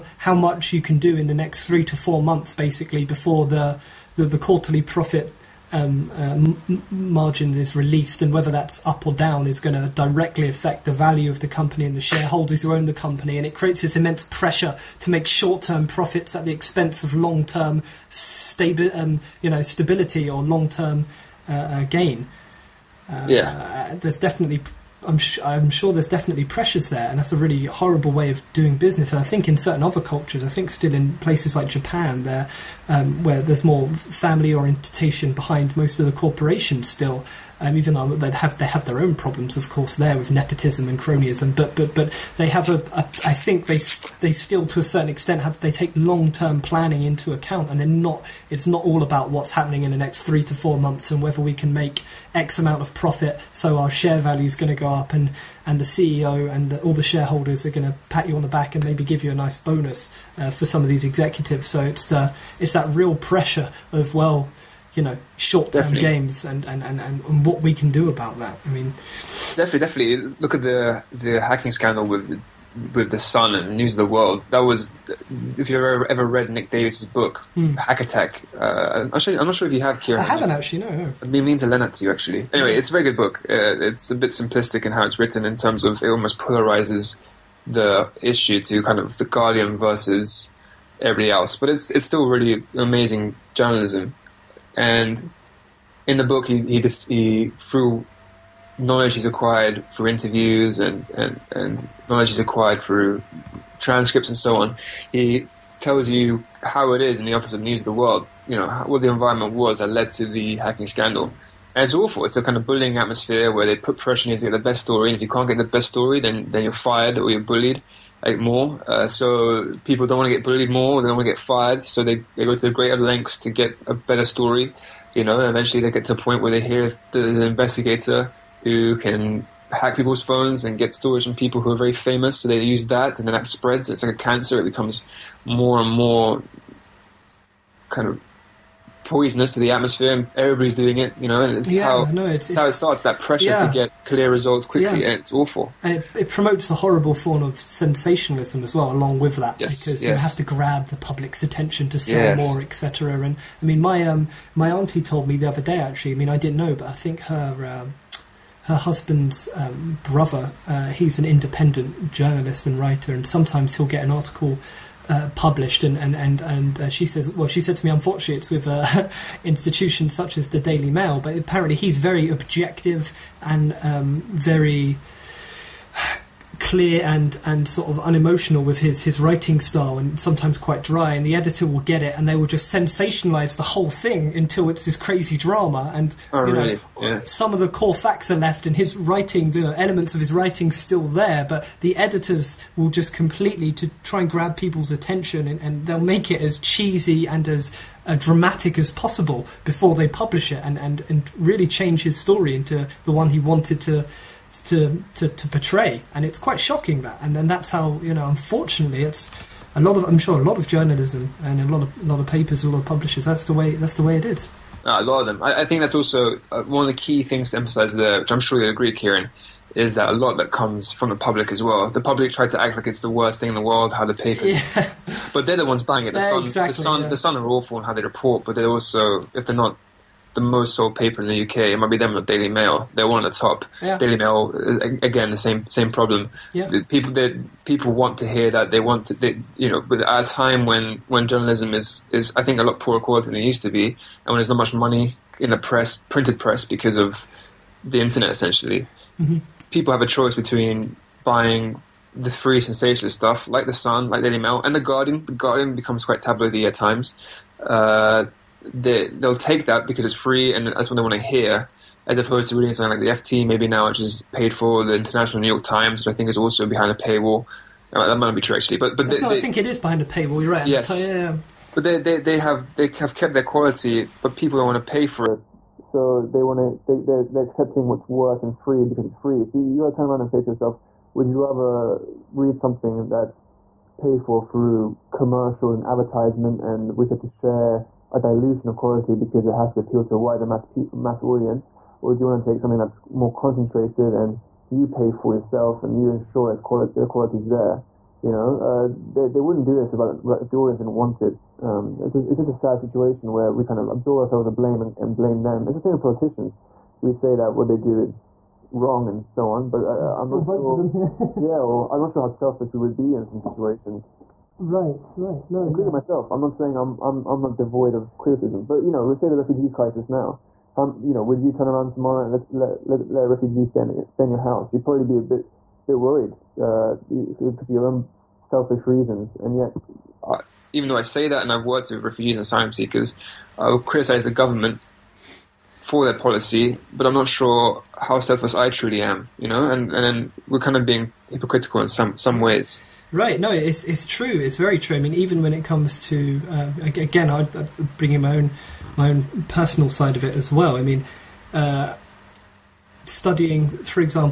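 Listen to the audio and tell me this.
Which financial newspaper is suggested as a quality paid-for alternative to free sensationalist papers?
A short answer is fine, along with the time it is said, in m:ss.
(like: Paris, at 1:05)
the FT, at 4:23.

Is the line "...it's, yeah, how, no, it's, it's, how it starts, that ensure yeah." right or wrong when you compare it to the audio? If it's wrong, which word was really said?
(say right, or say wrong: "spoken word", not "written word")
wrong: "pressure", not "ensure".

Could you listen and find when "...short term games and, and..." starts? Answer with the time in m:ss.
1:05.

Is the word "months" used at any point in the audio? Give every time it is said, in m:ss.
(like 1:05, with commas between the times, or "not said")
0:02, 0:50.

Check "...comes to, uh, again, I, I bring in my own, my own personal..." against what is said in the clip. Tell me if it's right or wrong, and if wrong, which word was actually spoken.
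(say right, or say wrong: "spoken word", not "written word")
right.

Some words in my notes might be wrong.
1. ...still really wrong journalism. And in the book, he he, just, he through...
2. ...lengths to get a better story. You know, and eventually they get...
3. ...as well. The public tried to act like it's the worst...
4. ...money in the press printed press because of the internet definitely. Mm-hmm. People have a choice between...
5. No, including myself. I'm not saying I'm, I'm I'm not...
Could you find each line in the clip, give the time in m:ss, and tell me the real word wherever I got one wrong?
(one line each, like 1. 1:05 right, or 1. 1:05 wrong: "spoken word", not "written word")
1. 1:32 wrong: "amazing", not "wrong"
2. 2:02 right
3. 3:41 right
4. 4:04 wrong: "essentially", not "definitely"
5. 5:15 right.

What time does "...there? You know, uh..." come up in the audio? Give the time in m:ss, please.
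4:57.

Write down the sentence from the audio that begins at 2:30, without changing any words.
you have to grab the public's attention to sell yes.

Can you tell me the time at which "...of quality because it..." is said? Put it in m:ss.
4:48.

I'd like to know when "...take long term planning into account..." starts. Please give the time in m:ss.
0:45.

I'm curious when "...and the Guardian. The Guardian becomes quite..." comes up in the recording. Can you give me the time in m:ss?
4:14.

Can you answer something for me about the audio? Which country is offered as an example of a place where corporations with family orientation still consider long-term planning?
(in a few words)
Japan.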